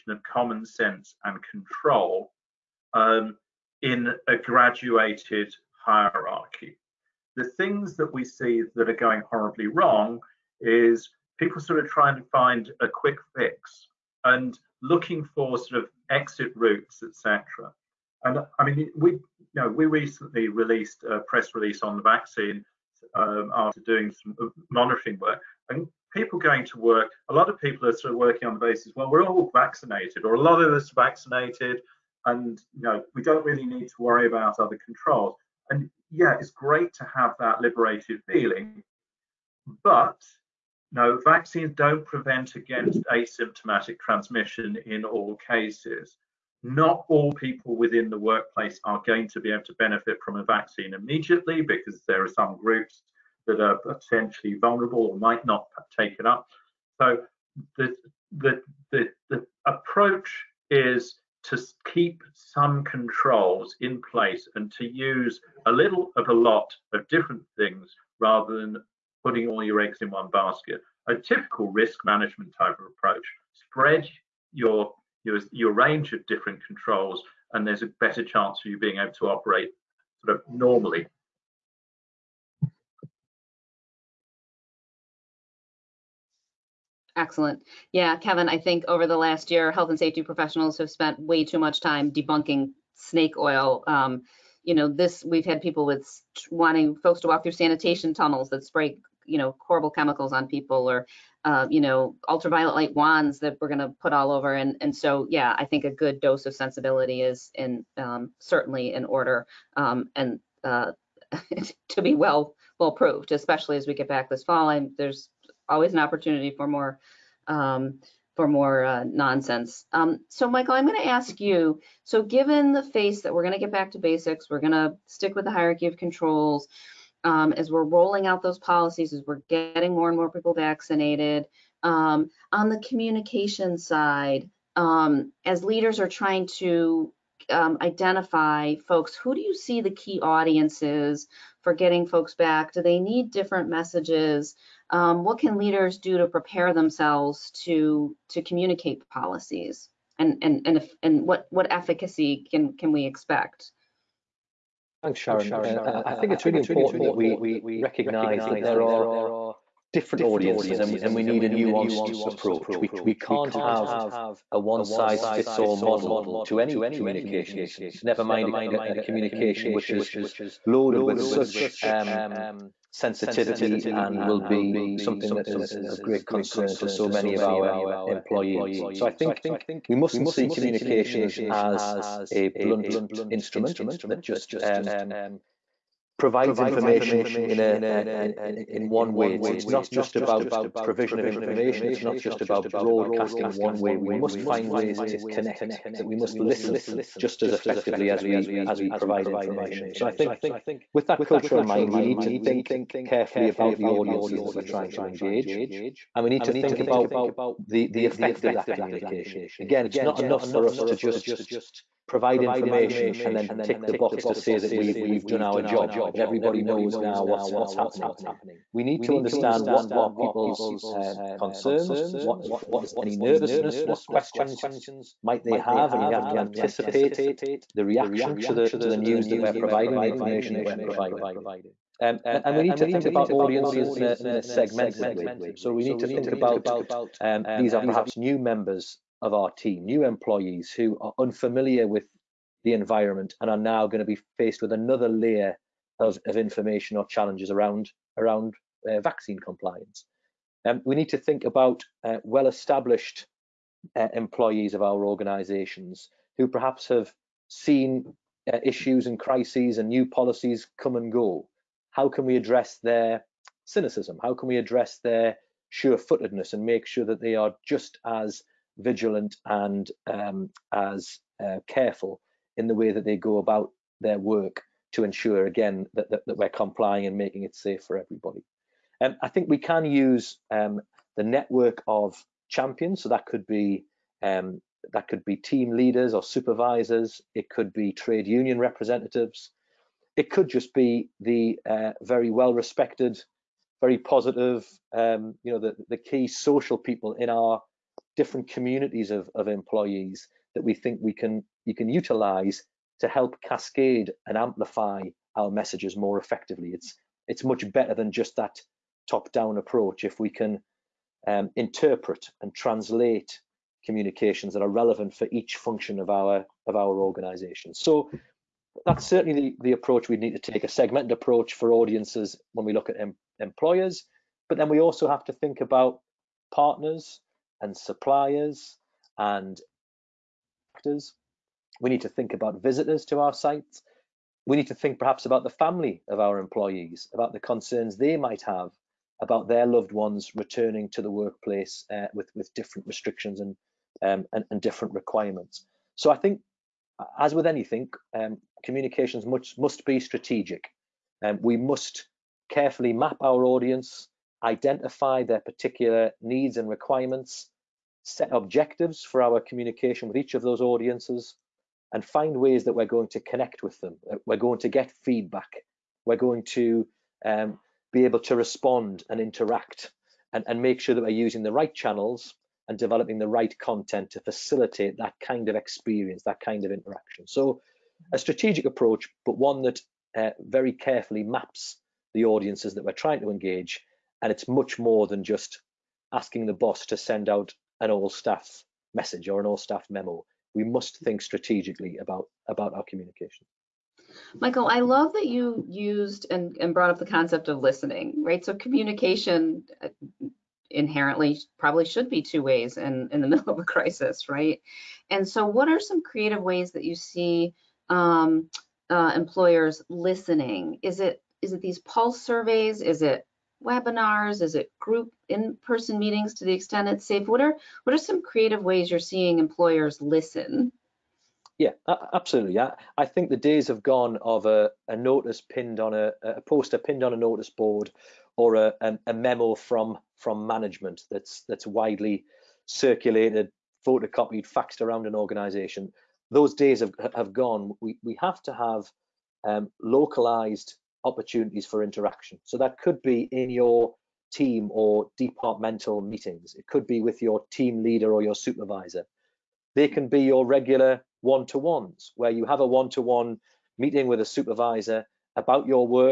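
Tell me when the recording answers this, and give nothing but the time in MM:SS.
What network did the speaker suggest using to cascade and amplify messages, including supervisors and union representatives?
04:41.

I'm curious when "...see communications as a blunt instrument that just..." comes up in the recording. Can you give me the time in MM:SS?
03:00.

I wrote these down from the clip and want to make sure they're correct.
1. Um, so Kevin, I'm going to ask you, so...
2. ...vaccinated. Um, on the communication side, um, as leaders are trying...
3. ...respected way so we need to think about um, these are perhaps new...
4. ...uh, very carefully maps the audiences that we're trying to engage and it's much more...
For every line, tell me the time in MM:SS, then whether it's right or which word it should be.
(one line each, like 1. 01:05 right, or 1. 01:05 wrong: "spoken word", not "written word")
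1. 01:59 wrong: "Michael", not "Kevin"
2. 02:10 right
3. 03:54 wrong: "segmented", not "respected"
4. 06:20 right.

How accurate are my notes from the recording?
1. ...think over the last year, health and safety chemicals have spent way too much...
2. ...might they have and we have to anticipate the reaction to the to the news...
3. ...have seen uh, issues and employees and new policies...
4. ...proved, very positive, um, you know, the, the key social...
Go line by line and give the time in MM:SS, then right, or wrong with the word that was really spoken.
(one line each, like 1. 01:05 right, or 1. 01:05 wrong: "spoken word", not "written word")
1. 01:28 wrong: "professionals", not "chemicals"
2. 03:45 right
3. 04:16 wrong: "crises", not "employees"
4. 04:52 wrong: "respected", not "proved".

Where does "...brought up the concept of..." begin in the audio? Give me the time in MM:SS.
06:36.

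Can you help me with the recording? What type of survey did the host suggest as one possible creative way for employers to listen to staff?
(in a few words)
Pulse surveys.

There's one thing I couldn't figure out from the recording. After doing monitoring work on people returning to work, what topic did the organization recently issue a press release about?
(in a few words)
The vaccine.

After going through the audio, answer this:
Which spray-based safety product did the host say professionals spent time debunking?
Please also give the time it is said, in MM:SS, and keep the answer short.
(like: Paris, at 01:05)
Sanitation tunnels, at 01:37.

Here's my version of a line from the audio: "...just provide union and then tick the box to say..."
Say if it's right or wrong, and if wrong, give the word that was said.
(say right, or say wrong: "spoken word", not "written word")
wrong: "information", not "union".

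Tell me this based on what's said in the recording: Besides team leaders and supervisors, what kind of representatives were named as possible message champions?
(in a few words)
Trade union representatives.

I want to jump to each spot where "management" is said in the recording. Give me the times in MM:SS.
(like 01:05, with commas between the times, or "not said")
01:12, 07:10.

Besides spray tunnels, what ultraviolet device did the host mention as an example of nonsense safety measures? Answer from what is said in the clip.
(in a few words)
Ultraviolet light wands.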